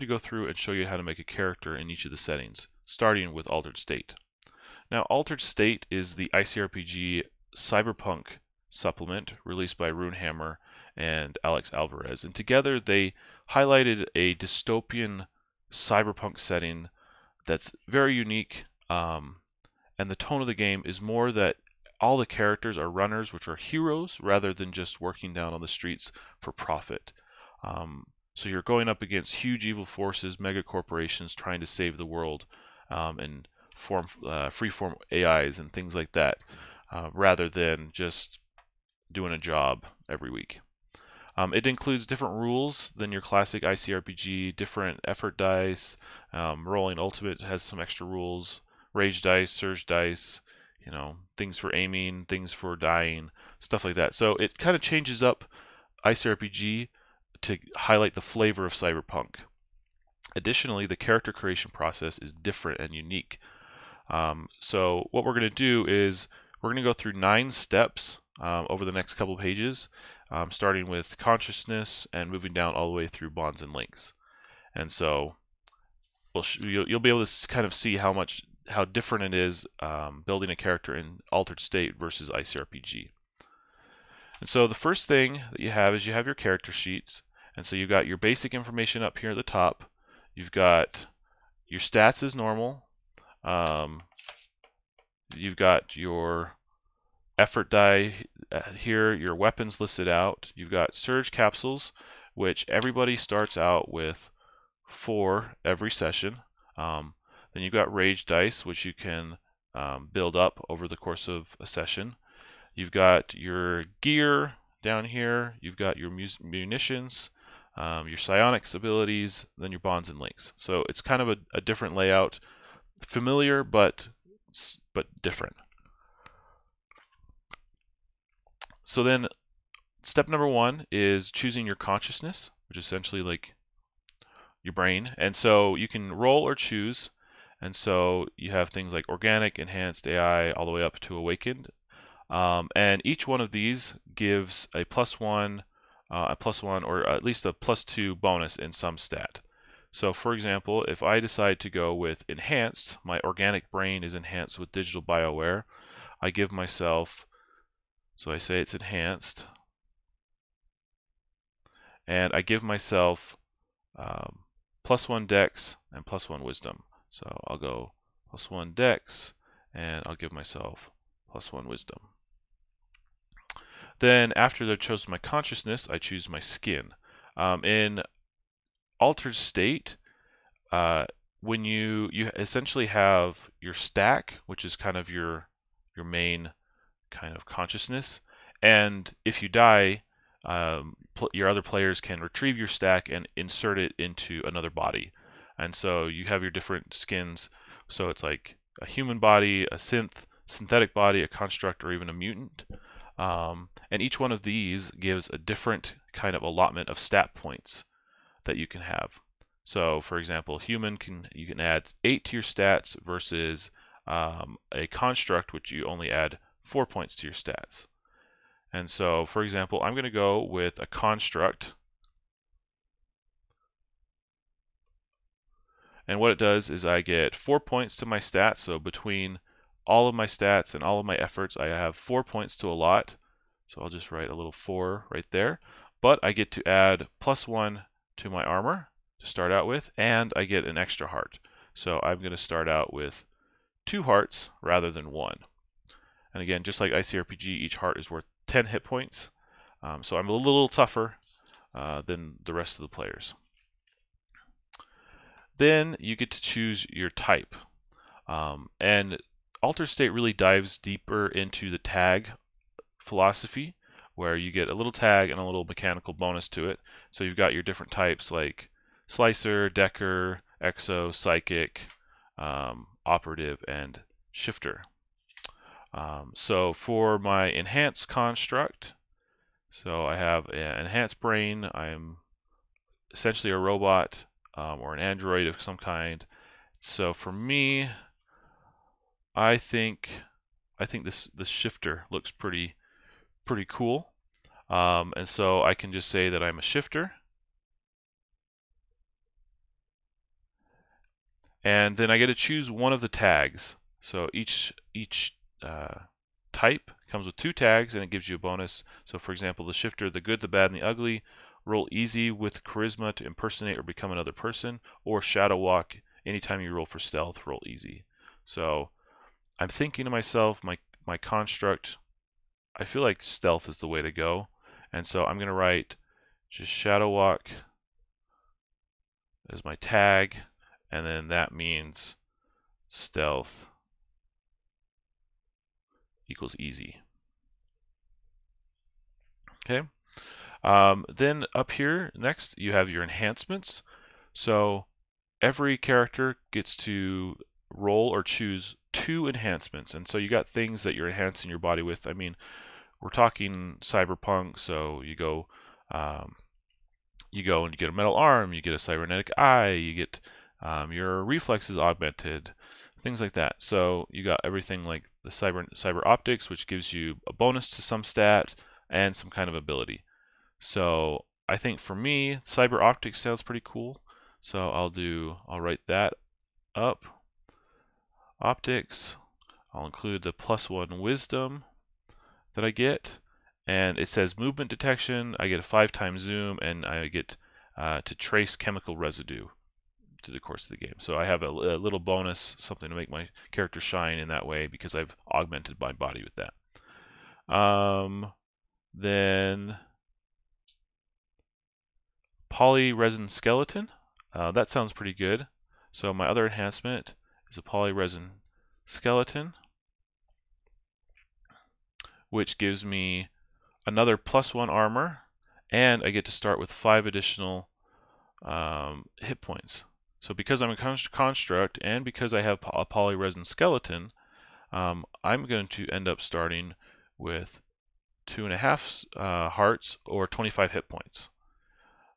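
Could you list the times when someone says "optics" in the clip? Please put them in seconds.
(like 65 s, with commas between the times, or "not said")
366 s, 372 s, 378 s.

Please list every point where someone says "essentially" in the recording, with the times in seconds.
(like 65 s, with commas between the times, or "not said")
132 s, 182 s, 283 s.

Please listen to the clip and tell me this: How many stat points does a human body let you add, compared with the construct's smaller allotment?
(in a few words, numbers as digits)
8.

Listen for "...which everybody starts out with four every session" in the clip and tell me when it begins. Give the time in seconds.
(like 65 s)
102 s.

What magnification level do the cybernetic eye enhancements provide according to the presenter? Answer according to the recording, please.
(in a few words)
5x zoom.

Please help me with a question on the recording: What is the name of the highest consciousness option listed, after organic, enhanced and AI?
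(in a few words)
Awakened.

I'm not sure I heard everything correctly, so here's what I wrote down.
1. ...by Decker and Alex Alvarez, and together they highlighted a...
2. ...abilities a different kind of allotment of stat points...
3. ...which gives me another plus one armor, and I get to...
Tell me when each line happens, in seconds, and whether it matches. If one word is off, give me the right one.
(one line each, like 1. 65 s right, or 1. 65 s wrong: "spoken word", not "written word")
1. 9 s wrong: "Runehammer", not "Decker"
2. 204 s wrong: "gives", not "abilities"
3. 412 s right.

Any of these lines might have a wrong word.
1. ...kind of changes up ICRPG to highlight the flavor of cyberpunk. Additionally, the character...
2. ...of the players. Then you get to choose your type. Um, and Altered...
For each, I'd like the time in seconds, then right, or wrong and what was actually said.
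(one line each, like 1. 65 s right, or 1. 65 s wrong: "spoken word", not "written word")
1. 54 s right
2. 252 s right.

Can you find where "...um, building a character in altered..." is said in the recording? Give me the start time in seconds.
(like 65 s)
79 s.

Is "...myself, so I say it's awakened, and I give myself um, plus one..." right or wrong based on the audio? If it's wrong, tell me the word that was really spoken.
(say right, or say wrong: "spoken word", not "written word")
wrong: "enhanced", not "awakened".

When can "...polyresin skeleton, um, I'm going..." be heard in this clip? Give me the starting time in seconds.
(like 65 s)
422 s.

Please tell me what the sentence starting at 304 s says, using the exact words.
So each each uh, type comes with two tags and it gives you a bonus.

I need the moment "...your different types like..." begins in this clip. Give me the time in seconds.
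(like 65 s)
267 s.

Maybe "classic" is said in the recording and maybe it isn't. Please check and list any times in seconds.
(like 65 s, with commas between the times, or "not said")
43 s.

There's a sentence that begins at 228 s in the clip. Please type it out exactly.
So between all of my stats and all of my efforts, I have four points to a lot.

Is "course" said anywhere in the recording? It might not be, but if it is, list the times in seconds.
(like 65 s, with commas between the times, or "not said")
110 s, 390 s.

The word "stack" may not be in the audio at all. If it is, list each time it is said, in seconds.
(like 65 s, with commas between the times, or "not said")
183 s, 192 s.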